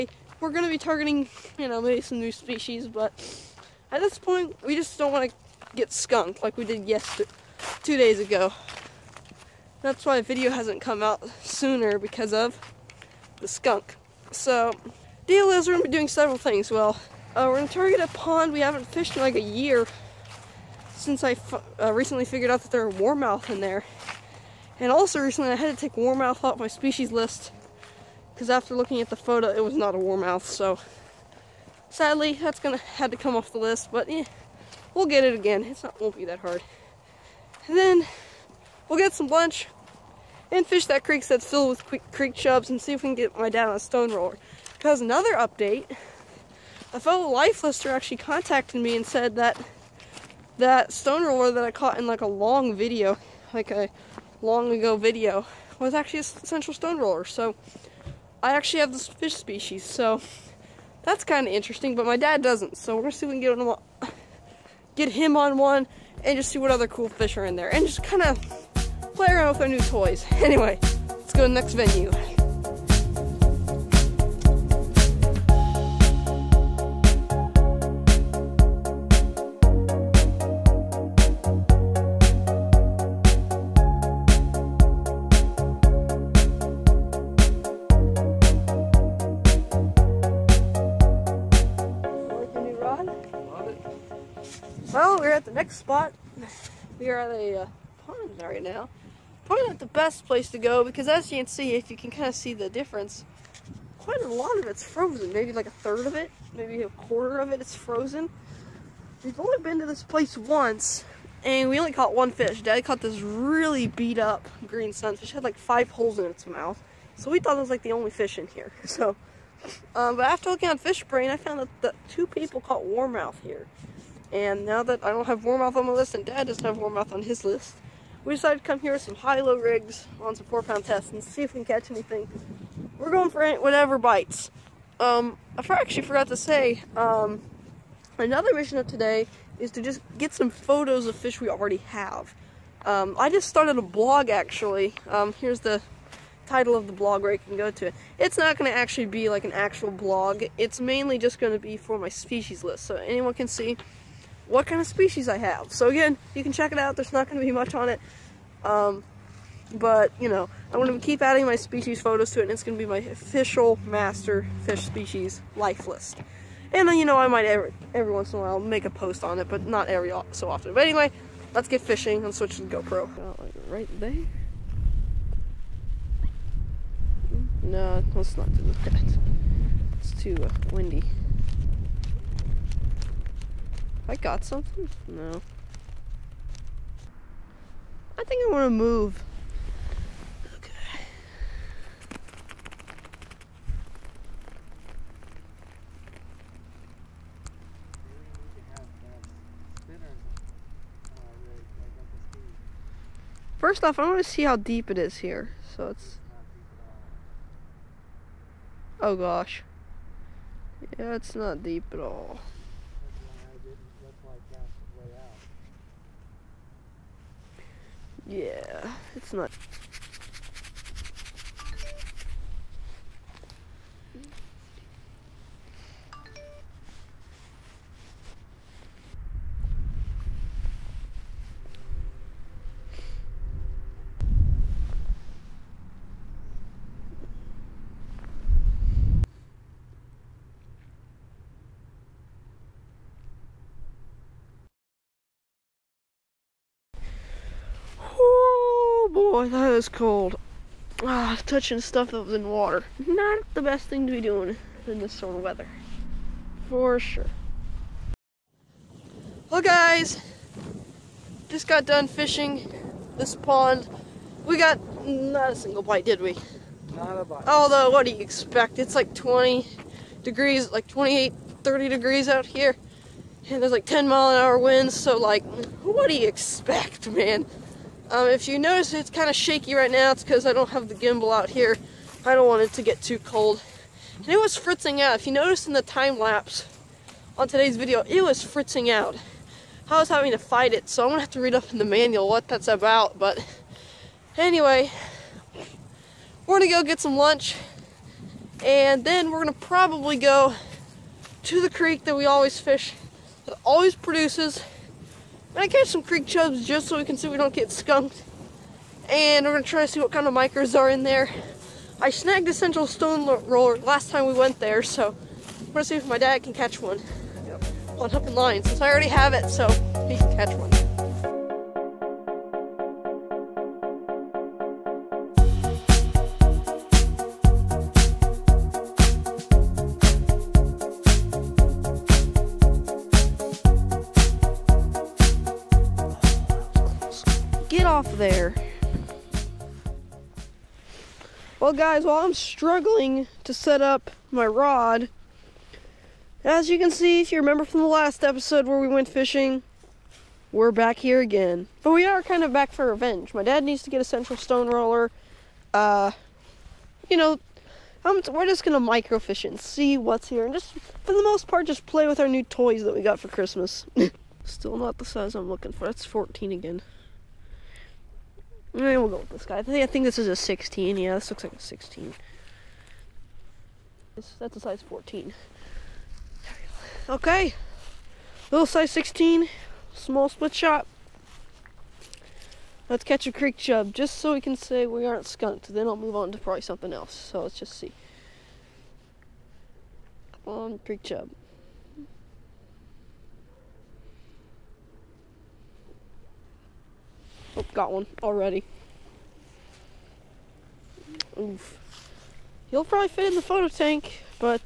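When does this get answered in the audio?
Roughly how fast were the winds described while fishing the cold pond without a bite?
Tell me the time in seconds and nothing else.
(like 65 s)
273 s.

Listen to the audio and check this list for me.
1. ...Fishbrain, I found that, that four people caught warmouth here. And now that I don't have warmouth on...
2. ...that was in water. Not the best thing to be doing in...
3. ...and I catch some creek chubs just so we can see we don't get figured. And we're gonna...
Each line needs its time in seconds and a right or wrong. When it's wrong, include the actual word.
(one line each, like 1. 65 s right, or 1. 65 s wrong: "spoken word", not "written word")
1. 120 s wrong: "two", not "four"
2. 252 s right
3. 305 s wrong: "skunked", not "figured".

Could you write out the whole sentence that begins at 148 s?
It's not going to actually be like an actual blog.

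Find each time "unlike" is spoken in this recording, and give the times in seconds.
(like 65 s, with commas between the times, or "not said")
not said.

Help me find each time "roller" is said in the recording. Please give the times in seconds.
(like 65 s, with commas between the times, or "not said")
44 s, 51 s, 56 s, 313 s, 354 s.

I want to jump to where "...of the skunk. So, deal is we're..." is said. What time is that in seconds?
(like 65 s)
12 s.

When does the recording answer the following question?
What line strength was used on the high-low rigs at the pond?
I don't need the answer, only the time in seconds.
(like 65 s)
130 s.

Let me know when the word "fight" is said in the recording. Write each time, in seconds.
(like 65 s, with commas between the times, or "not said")
290 s.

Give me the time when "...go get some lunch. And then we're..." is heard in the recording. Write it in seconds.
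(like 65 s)
296 s.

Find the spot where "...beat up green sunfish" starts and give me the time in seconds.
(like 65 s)
113 s.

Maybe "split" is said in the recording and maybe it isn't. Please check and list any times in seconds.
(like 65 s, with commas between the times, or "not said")
380 s.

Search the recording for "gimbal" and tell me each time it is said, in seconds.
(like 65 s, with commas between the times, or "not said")
280 s.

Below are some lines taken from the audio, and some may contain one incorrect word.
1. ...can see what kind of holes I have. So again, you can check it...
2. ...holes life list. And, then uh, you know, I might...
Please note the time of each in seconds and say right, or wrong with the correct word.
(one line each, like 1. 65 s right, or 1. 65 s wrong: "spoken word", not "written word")
1. 153 s wrong: "species", not "holes"
2. 164 s wrong: "species", not "holes".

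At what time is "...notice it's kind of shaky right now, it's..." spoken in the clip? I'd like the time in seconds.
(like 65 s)
278 s.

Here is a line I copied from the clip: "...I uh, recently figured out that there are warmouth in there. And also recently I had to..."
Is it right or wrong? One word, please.
right.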